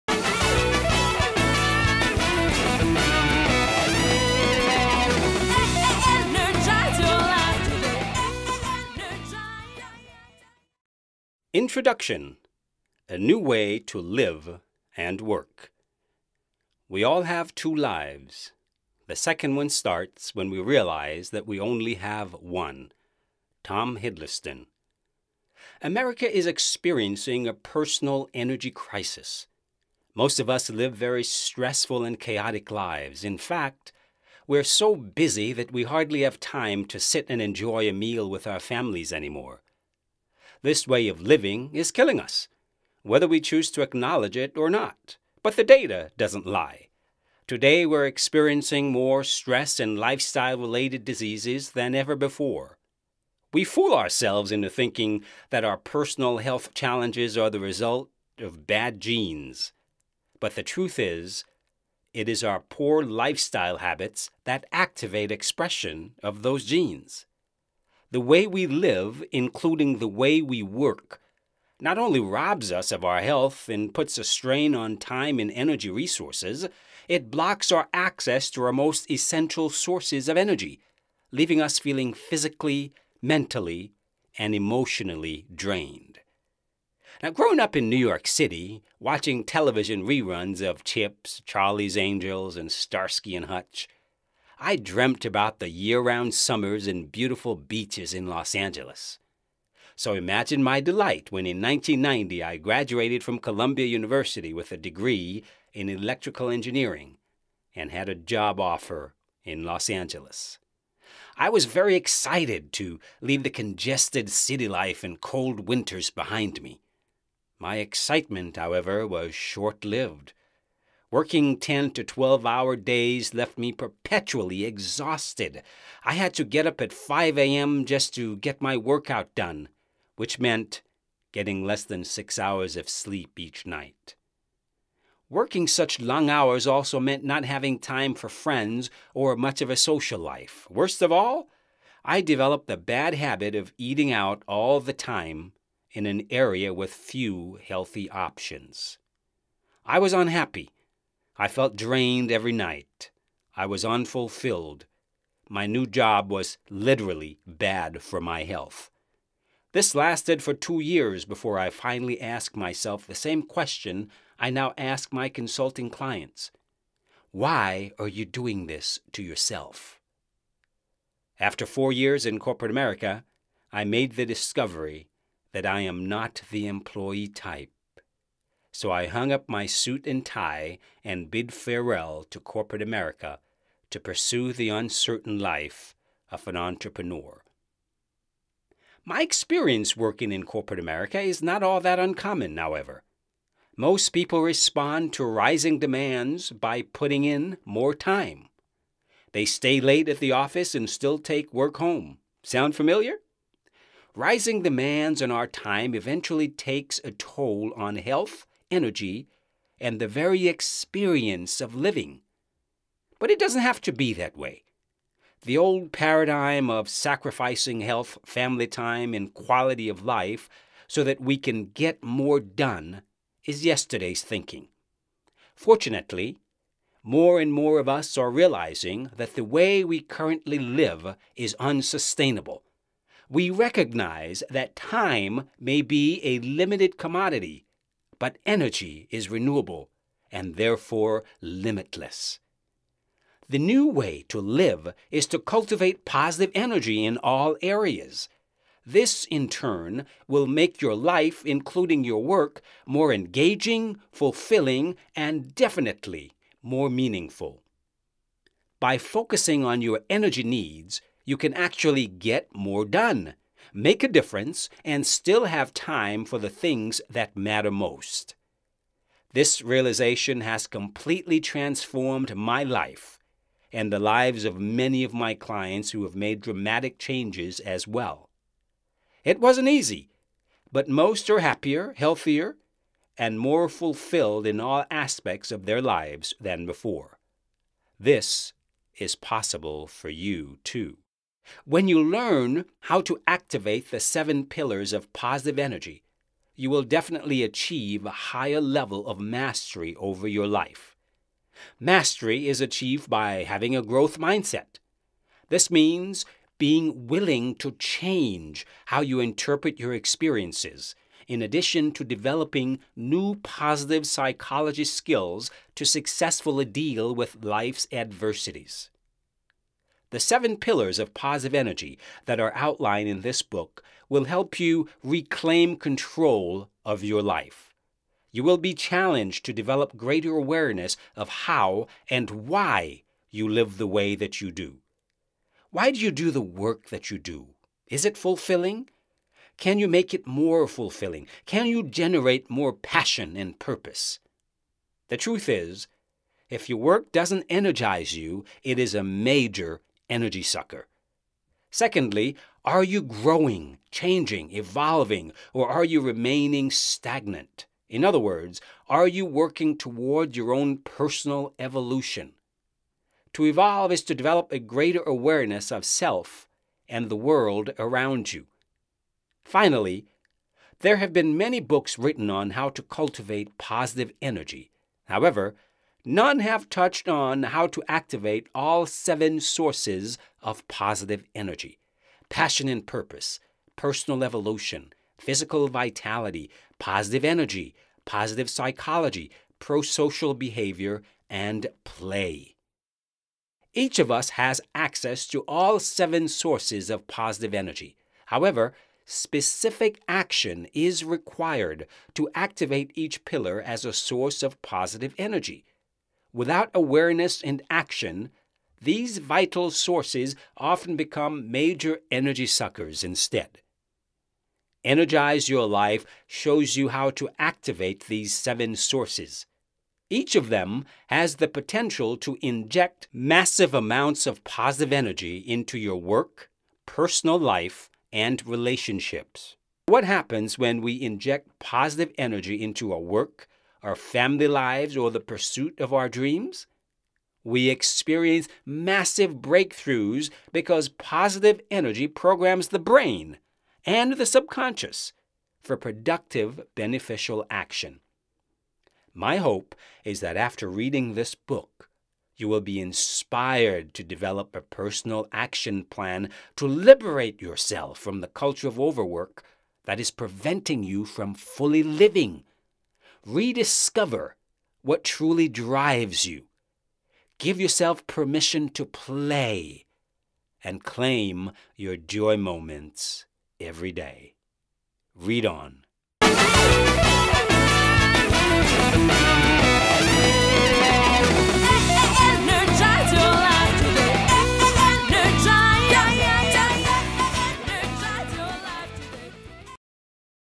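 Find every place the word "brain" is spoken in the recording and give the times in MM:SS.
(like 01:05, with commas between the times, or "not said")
07:22.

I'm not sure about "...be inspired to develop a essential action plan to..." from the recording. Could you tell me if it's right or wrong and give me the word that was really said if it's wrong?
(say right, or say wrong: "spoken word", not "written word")
wrong: "personal", not "essential".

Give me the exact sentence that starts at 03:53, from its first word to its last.
We recognize that time may be a limited commodity but energy is renewable and therefore limitless.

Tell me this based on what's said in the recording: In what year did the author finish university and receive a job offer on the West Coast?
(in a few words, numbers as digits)
1990.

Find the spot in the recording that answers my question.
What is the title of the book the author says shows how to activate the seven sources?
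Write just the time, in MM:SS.
06:54.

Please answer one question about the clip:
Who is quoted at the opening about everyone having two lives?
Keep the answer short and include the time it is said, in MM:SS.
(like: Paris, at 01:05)
Tom Hiddleston, at 00:23.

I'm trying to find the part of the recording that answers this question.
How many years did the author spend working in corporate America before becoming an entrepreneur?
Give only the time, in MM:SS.
02:51.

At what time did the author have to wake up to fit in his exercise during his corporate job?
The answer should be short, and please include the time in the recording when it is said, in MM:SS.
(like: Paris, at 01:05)
5 a.m., at 02:06.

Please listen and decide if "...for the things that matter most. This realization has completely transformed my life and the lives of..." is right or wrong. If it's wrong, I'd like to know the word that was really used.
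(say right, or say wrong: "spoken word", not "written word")
right.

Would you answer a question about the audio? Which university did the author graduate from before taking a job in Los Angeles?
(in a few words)
Columbia University.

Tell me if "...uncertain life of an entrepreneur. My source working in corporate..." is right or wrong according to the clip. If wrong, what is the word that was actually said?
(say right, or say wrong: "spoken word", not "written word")
wrong: "experience", not "source".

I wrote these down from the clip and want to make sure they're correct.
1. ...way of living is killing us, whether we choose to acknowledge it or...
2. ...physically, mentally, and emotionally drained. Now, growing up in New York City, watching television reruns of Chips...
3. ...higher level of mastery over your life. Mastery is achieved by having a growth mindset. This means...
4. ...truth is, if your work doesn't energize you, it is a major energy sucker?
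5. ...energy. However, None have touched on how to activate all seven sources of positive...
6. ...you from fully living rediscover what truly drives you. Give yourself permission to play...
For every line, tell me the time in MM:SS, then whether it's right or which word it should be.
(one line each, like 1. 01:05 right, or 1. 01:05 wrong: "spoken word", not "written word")
1. 00:40 right
2. 01:22 right
3. 04:58 right
4. 05:45 right
5. 06:14 right
6. 07:40 right.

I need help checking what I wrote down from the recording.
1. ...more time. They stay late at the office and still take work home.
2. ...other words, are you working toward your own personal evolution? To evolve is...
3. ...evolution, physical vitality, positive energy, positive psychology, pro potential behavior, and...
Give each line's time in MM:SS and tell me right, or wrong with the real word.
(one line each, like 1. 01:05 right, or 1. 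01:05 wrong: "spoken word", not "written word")
1. 03:17 right
2. 05:58 right
3. 06:24 wrong: "social", not "potential".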